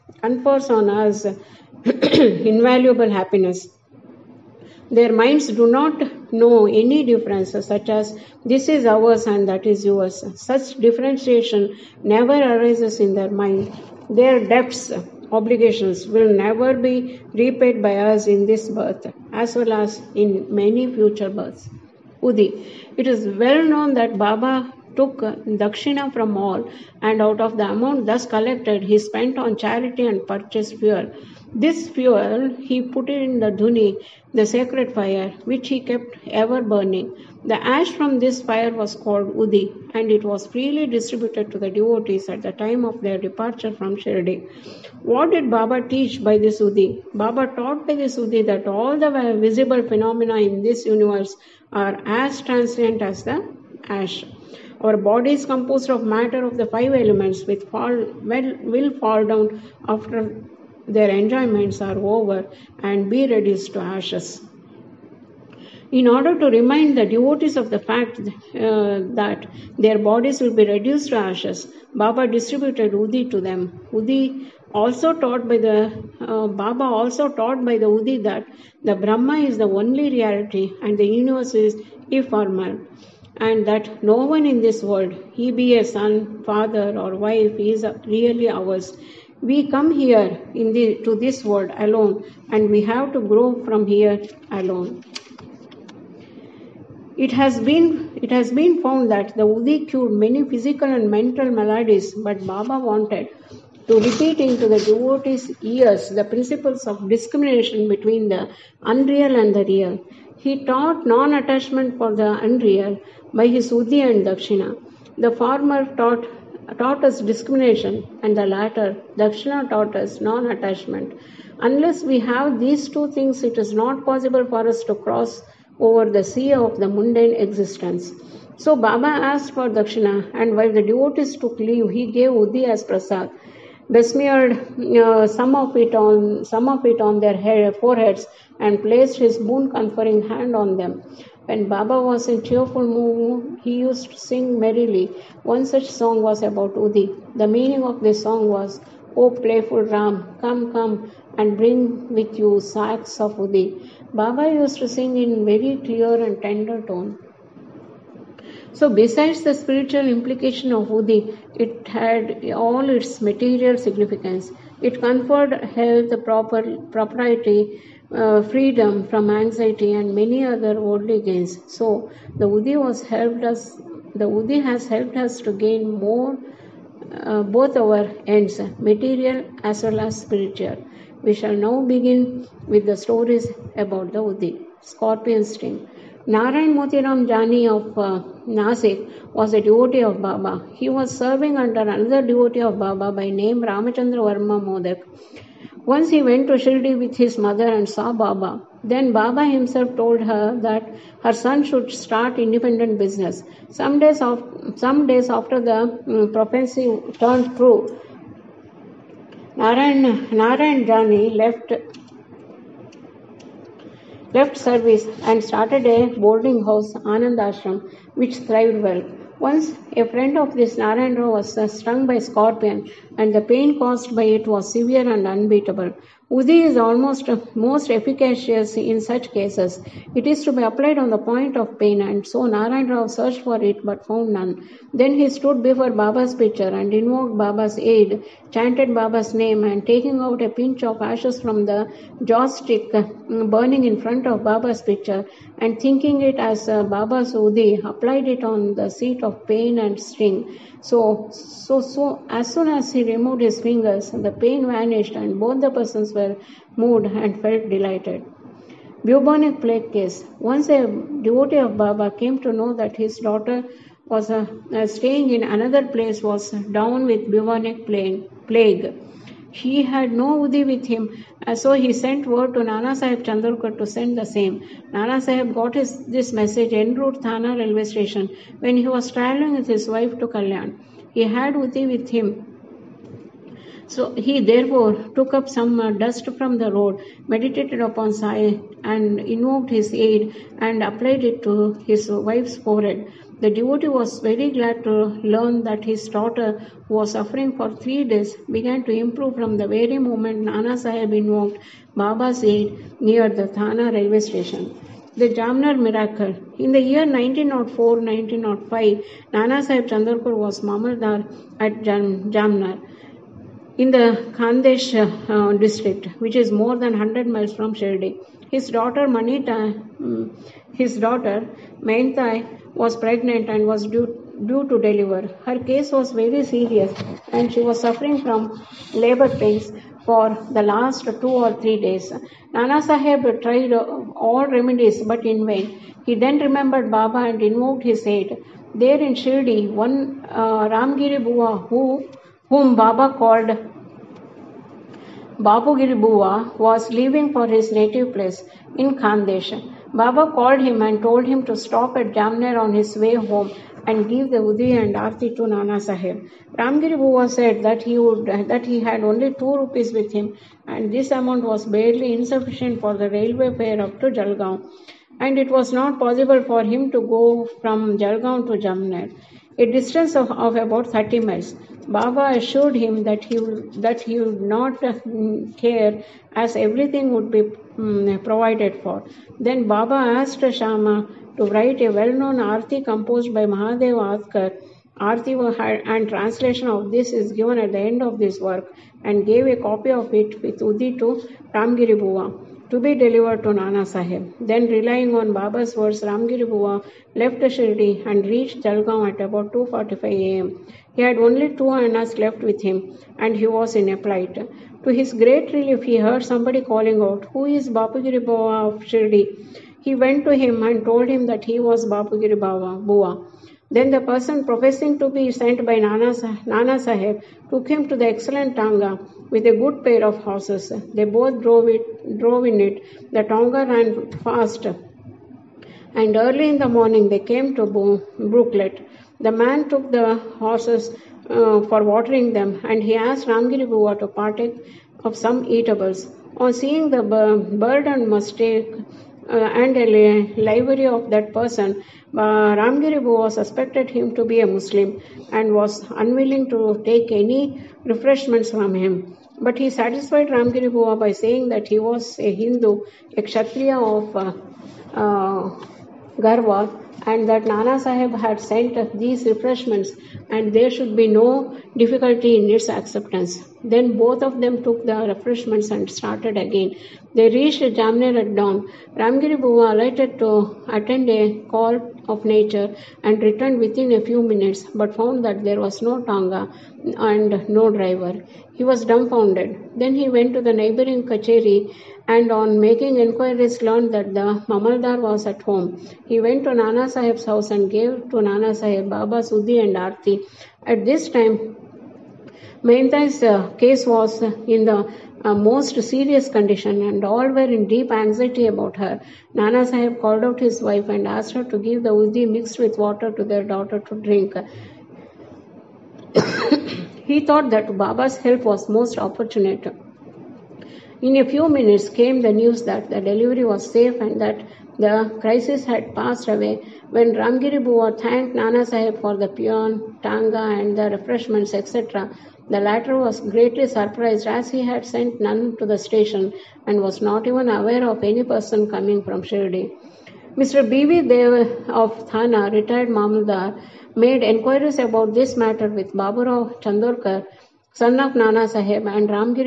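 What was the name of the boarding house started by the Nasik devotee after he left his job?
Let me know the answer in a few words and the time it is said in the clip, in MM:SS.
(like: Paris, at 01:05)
Anand Ashram, at 03:37.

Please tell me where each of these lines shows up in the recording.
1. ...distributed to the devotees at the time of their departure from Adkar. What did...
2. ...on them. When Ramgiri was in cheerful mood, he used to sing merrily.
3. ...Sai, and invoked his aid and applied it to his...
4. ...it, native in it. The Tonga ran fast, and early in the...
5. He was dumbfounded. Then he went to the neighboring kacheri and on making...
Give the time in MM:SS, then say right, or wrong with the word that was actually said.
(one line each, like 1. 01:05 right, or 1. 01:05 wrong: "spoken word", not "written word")
1. 00:40 wrong: "Shirdi", not "Adkar"
2. 02:20 wrong: "Baba", not "Ramgiri"
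3. 04:48 right
4. 07:01 wrong: "drove", not "native"
5. 07:58 right.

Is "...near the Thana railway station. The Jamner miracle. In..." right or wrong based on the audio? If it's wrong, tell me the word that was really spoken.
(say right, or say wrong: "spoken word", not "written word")
right.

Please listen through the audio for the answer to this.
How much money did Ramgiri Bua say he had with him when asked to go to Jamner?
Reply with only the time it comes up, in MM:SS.
05:59.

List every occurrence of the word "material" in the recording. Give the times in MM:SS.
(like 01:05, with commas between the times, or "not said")
02:43, 02:58.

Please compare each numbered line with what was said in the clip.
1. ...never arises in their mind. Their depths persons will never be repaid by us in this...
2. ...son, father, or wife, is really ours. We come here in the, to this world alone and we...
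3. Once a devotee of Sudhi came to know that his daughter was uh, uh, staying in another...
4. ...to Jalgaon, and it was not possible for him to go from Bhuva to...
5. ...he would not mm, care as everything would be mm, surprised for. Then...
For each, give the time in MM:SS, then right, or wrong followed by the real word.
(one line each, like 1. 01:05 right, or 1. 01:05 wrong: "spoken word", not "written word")
1. 00:12 wrong: "obligations", not "persons"
2. 01:25 right
3. 04:20 wrong: "Baba", not "Sudhi"
4. 06:04 wrong: "Jalgaon", not "Bhuva"
5. 06:14 wrong: "provided", not "surprised".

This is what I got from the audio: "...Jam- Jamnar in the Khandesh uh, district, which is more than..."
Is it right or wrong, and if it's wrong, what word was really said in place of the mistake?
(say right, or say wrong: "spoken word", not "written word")
right.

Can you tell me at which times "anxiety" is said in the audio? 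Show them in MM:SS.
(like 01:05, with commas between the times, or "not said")
02:49, 08:17.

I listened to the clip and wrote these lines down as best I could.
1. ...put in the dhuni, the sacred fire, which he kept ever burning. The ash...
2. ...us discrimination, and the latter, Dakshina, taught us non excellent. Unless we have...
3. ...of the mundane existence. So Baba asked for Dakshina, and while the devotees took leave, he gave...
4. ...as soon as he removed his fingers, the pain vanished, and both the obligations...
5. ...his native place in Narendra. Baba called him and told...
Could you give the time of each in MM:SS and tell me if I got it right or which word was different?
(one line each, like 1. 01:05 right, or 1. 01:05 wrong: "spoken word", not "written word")
1. 00:32 right
2. 01:57 wrong: "attachment", not "excellent"
3. 02:06 right
4. 04:12 wrong: "persons", not "obligations"
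5. 05:47 wrong: "Khandesh", not "Narendra".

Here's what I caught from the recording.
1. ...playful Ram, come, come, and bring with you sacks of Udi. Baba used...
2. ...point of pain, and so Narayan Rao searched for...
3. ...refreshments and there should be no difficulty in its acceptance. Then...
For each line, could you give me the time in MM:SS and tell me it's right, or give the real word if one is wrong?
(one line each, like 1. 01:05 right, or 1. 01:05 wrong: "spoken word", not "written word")
1. 02:29 right
2. 03:51 right
3. 07:39 right.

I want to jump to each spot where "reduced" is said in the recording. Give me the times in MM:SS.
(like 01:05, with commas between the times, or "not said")
01:03, 01:10.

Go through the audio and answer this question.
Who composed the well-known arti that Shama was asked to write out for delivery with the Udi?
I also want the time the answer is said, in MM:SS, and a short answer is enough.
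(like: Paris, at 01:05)
Mahadev Adkar, at 06:23.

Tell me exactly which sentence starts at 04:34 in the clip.
Nana Sahib got his, this message en route Thana railway station when he was traveling with his wife to Kalyan.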